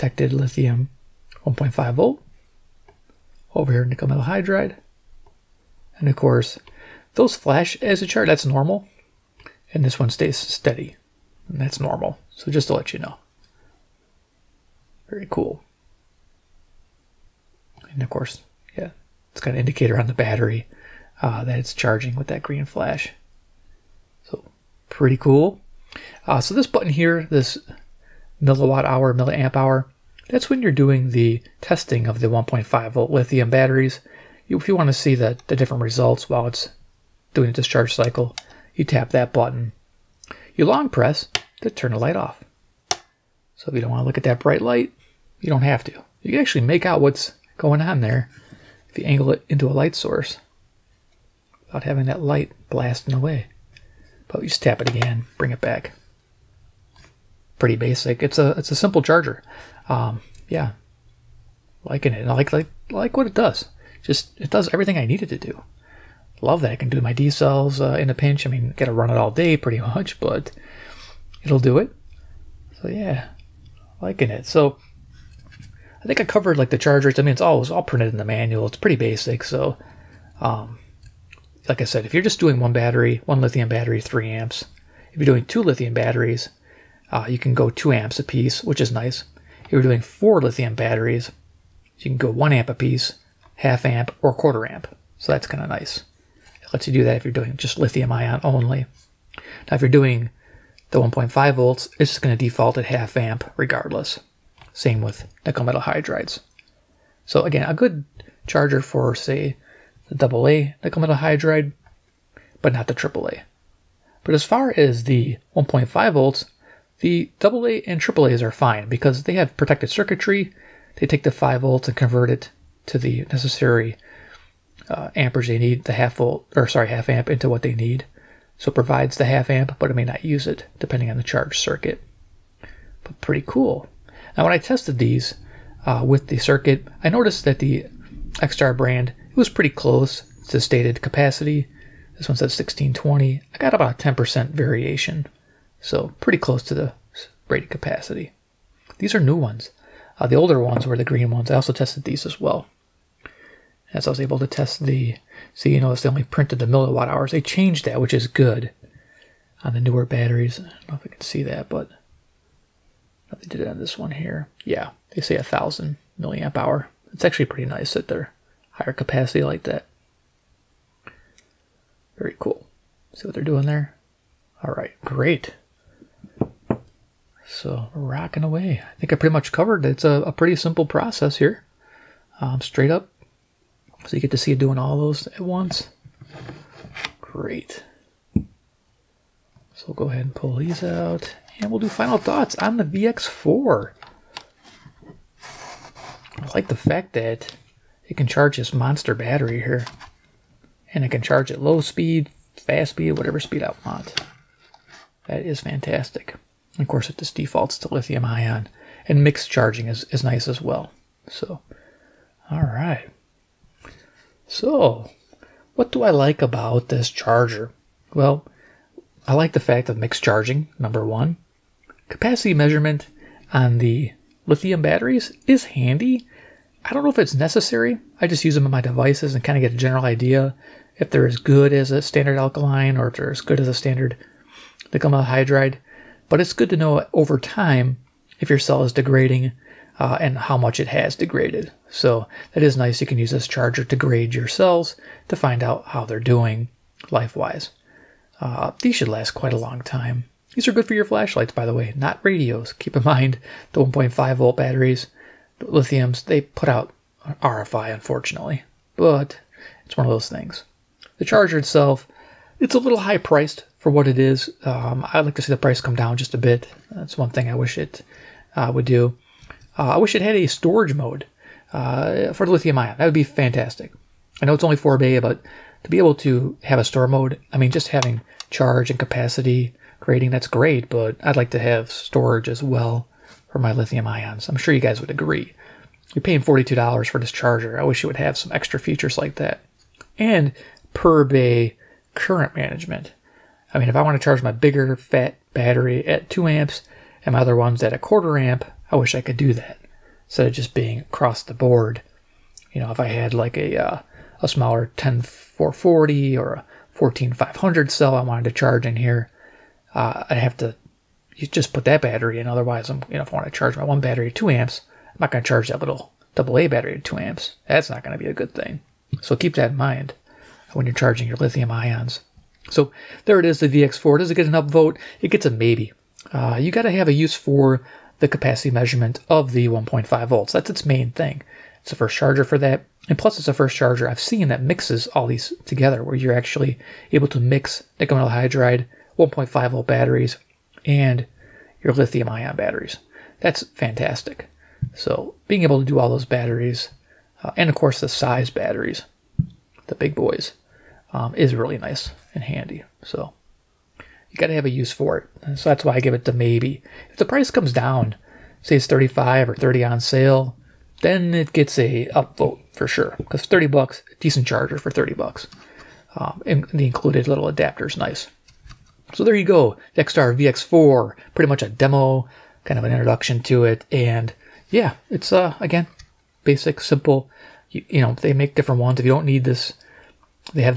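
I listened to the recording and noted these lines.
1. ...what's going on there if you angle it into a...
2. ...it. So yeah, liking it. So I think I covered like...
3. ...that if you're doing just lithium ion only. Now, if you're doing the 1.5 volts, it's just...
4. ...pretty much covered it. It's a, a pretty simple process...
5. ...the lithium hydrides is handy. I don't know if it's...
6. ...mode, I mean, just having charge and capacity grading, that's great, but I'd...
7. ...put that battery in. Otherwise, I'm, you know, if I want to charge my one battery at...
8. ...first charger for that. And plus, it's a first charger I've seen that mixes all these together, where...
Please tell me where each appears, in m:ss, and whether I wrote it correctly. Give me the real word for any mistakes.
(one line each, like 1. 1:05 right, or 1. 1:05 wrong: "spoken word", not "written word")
1. 0:47 right
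2. 1:11 right
3. 1:37 right
4. 2:59 right
5. 3:43 wrong: "batteries", not "hydrides"
6. 4:37 right
7. 5:11 right
8. 5:31 right.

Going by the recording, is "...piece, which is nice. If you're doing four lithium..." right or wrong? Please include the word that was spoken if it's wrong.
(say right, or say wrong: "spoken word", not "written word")
right.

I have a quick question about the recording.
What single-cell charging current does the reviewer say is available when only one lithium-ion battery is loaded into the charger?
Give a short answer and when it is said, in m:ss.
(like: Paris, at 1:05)
3 amps, at 1:23.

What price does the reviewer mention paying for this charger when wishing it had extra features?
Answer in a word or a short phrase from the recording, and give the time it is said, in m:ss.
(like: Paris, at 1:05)
$42, at 4:46.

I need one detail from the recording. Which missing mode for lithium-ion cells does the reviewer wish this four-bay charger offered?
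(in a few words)
storage mode.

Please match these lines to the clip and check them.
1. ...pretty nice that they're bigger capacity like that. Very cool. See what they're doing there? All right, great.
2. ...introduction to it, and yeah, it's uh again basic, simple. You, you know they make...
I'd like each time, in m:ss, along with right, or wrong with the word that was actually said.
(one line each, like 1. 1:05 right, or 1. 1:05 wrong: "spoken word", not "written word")
1. 2:47 wrong: "higher", not "bigger"
2. 6:12 right.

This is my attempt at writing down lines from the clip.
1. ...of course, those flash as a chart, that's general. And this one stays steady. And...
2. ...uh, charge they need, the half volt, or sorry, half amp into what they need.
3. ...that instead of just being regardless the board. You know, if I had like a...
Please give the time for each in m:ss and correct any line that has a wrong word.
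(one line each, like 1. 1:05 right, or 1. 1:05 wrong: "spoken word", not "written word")
1. 0:06 wrong: "normal", not "general"
2. 2:04 wrong: "amperage", not "charge"
3. 4:59 wrong: "across", not "regardless".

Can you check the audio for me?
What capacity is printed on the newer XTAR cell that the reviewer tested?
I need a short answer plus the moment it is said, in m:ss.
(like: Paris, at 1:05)
1620, at 2:22.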